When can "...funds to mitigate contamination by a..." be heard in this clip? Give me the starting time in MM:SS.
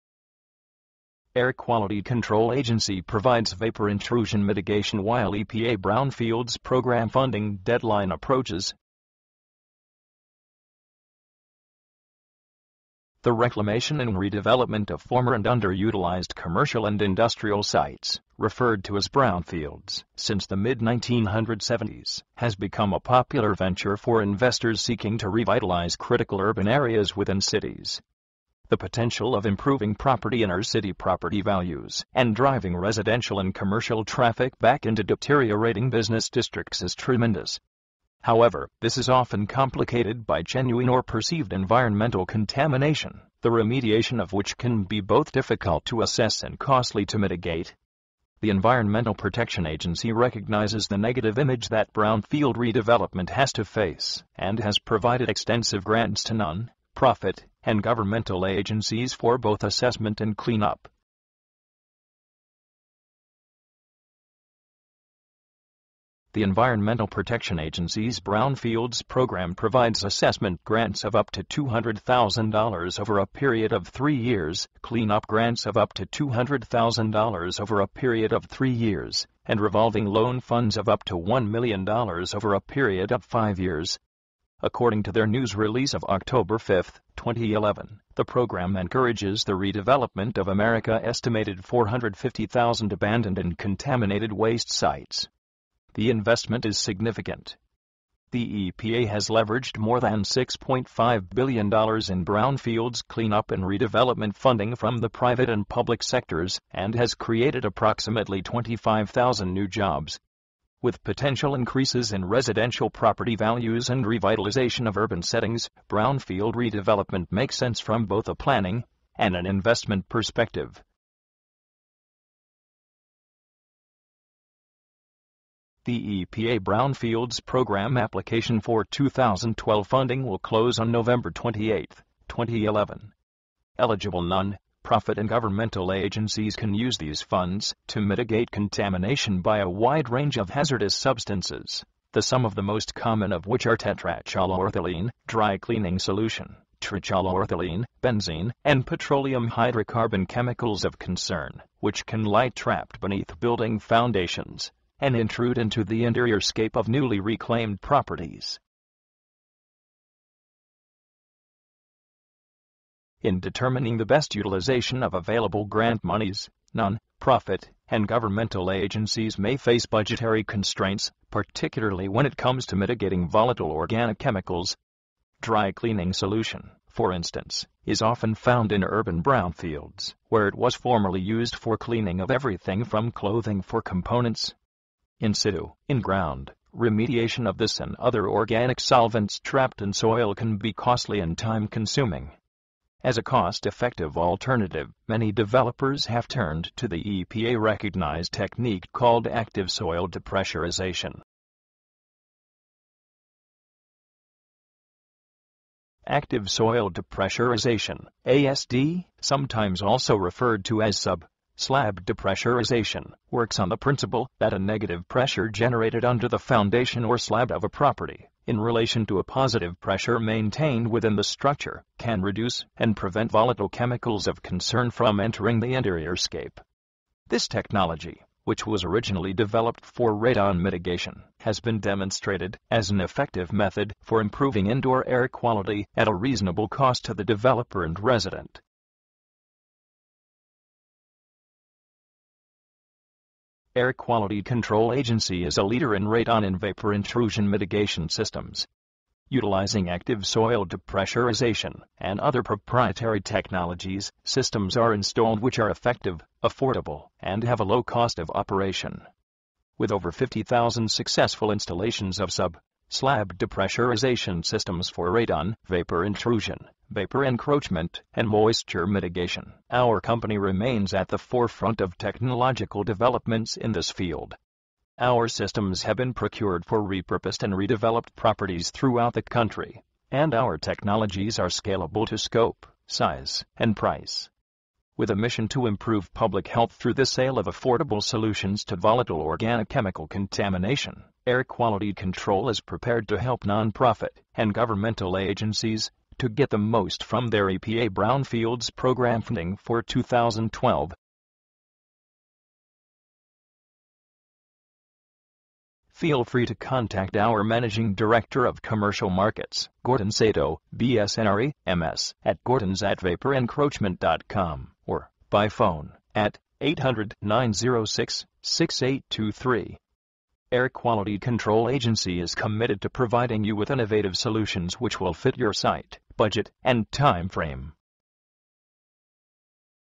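02:17.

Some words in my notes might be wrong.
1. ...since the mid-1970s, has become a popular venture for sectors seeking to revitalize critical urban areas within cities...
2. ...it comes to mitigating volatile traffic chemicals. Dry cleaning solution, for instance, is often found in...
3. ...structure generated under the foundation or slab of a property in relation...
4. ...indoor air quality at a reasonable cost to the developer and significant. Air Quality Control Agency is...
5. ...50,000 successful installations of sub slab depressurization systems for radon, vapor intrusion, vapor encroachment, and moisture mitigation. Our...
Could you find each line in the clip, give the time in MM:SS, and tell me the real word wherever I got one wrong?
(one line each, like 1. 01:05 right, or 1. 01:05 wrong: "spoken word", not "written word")
1. 00:20 wrong: "investors", not "sectors"
2. 02:52 wrong: "organic", not "traffic"
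3. 03:35 wrong: "pressure", not "structure"
4. 03:54 wrong: "resident", not "significant"
5. 04:20 right.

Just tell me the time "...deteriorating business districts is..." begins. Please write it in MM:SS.
00:35.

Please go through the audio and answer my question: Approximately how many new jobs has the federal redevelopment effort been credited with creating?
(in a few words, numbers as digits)
25,000.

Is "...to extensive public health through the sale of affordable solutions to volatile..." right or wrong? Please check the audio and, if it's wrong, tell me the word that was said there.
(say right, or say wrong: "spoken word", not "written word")
wrong: "improve", not "extensive".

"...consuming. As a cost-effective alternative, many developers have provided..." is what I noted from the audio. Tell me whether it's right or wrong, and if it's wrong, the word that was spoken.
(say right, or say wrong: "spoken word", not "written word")
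wrong: "turned", not "provided".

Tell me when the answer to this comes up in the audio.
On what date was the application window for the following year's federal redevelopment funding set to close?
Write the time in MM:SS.
02:10.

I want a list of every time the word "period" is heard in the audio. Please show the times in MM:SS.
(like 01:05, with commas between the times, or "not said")
01:13, 01:17, 01:22.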